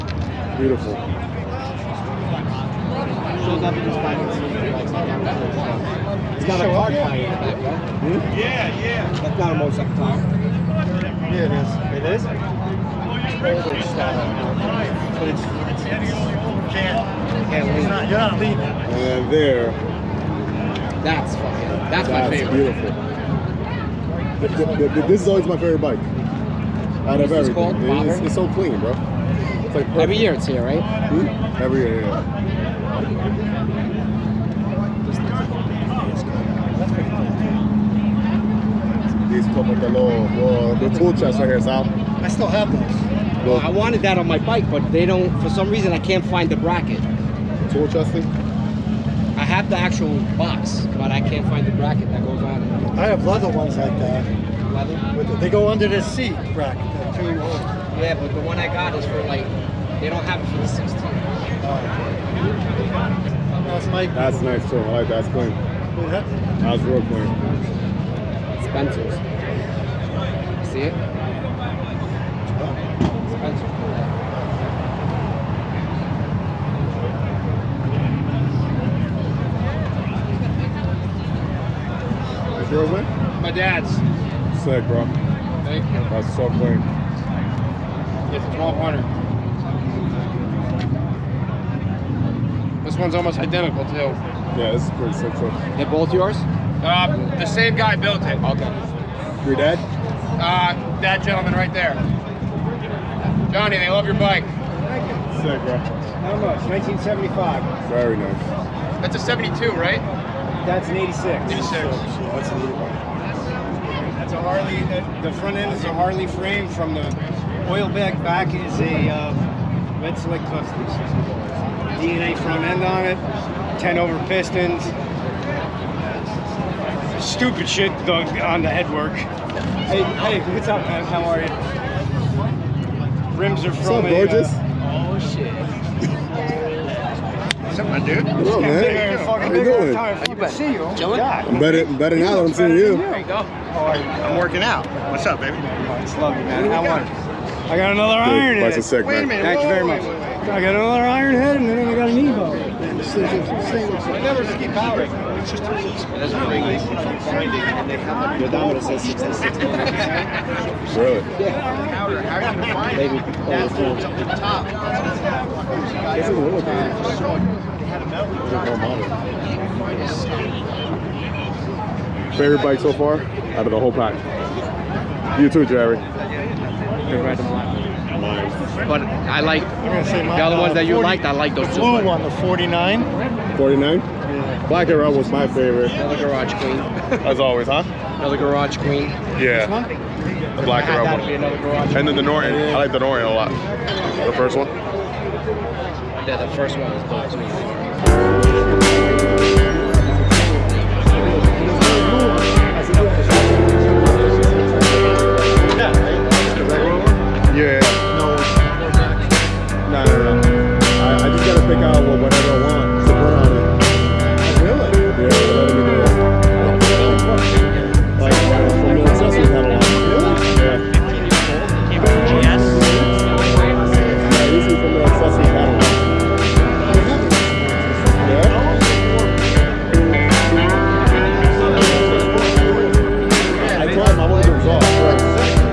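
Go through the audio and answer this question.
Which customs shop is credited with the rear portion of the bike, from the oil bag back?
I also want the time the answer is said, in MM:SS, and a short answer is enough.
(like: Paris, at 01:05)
Red Select Customs, at 02:00.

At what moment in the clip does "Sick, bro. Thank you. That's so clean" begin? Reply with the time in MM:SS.
01:24.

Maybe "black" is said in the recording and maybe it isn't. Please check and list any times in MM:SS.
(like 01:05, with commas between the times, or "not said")
03:04, 03:10.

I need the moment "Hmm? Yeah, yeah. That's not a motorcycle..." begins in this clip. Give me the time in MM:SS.
00:07.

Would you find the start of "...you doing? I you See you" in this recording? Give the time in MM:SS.
02:19.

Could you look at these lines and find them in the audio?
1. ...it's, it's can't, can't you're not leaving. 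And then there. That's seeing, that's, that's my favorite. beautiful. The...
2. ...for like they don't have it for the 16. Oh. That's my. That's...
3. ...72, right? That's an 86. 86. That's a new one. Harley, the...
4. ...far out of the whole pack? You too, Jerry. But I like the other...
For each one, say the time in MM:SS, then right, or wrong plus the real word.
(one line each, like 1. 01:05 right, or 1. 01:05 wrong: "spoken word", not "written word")
1. 00:13 wrong: "fucking", not "seeing"
2. 00:59 right
3. 01:49 right
4. 02:52 right.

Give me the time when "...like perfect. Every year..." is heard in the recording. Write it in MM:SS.
00:29.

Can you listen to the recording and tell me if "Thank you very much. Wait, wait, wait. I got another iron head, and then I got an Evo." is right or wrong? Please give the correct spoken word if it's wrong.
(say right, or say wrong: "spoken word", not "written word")
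right.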